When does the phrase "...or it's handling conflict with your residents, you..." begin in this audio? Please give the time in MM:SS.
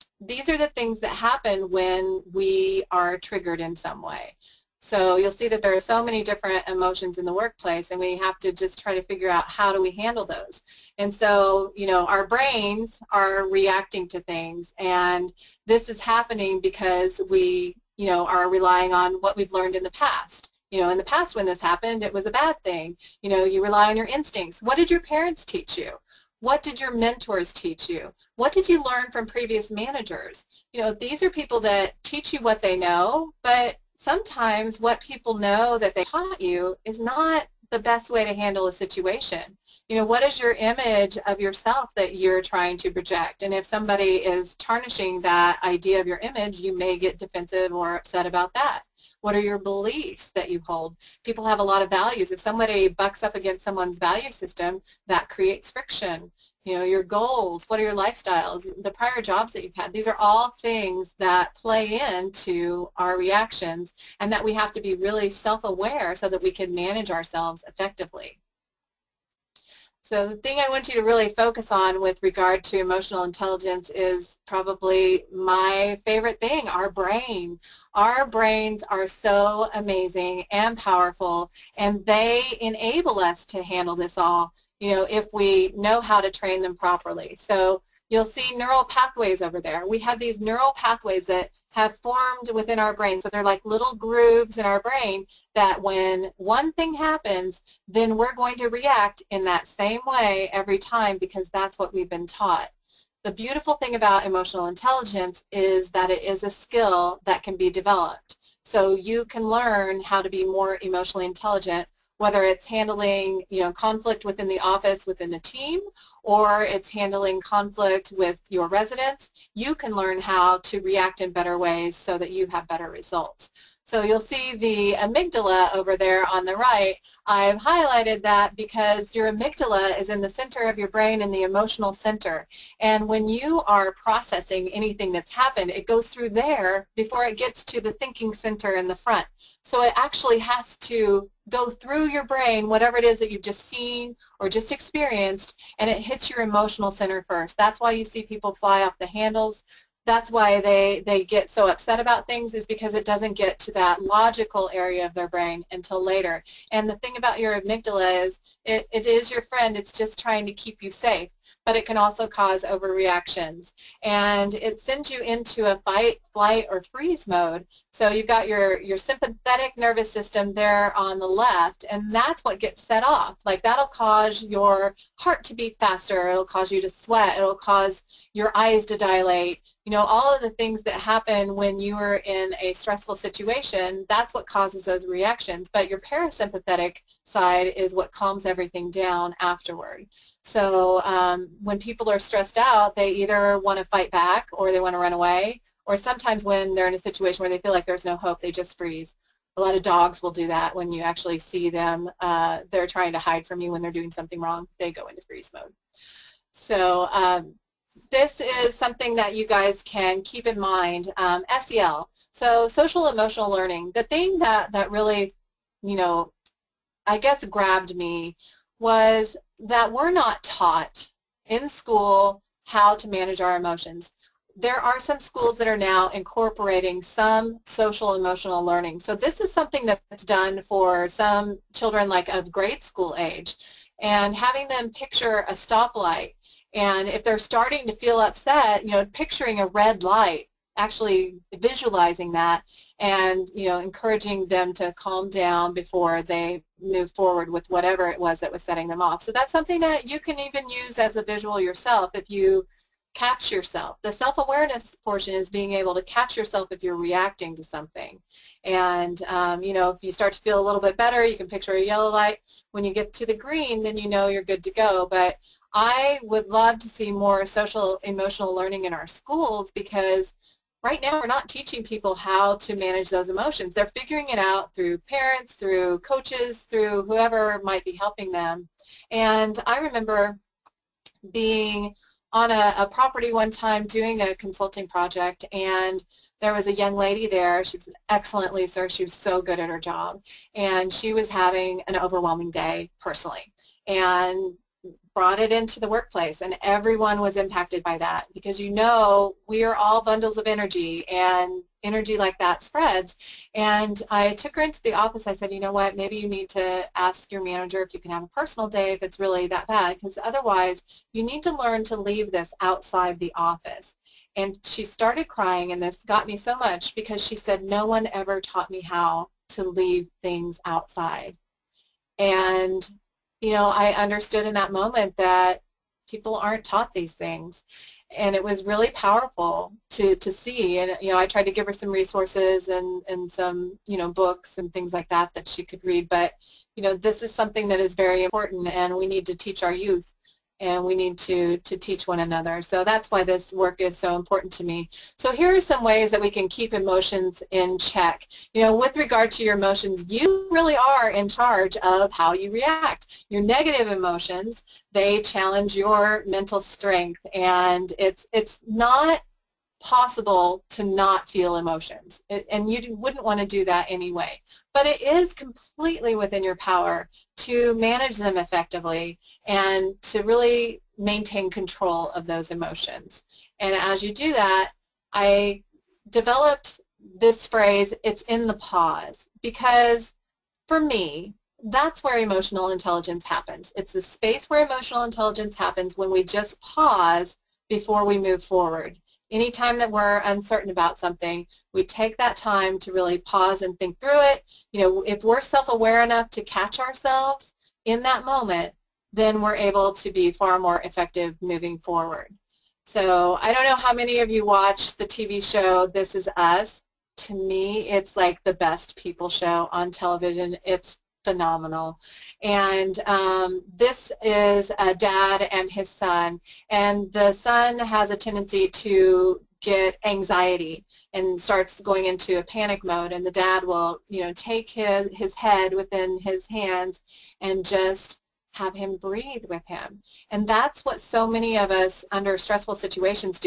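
01:56.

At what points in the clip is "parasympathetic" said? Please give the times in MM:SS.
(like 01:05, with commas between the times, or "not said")
03:05.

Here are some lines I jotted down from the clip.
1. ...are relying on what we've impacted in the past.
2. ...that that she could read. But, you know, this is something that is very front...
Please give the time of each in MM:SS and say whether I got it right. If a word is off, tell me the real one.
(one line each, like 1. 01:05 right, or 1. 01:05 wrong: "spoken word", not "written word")
1. 00:18 wrong: "learned", not "impacted"
2. 05:35 wrong: "important", not "front".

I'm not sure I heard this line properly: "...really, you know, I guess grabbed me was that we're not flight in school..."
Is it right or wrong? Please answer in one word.
wrong.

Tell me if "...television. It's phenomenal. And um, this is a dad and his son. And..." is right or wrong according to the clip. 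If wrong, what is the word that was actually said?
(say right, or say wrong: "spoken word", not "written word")
right.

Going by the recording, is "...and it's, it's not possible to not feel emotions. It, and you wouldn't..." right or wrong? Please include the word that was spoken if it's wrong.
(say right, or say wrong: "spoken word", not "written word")
right.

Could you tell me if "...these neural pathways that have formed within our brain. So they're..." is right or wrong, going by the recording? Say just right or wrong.
right.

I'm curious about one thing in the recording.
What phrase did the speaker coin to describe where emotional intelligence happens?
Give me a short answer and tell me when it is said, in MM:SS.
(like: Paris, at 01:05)
it's in the pause, at 06:18.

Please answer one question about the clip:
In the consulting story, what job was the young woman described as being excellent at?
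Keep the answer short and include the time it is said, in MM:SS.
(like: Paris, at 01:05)
leaser, at 04:48.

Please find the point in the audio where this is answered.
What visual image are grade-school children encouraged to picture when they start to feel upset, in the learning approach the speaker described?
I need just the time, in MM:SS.
03:55.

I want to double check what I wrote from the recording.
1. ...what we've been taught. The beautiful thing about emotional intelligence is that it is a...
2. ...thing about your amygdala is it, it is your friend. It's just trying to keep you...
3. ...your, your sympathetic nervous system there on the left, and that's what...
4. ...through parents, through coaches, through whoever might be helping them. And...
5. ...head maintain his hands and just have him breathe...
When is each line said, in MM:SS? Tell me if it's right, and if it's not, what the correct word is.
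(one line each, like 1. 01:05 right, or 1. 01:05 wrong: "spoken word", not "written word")
1. 01:41 right
2. 02:36 right
3. 02:48 right
4. 04:34 right
5. 07:05 wrong: "within", not "maintain".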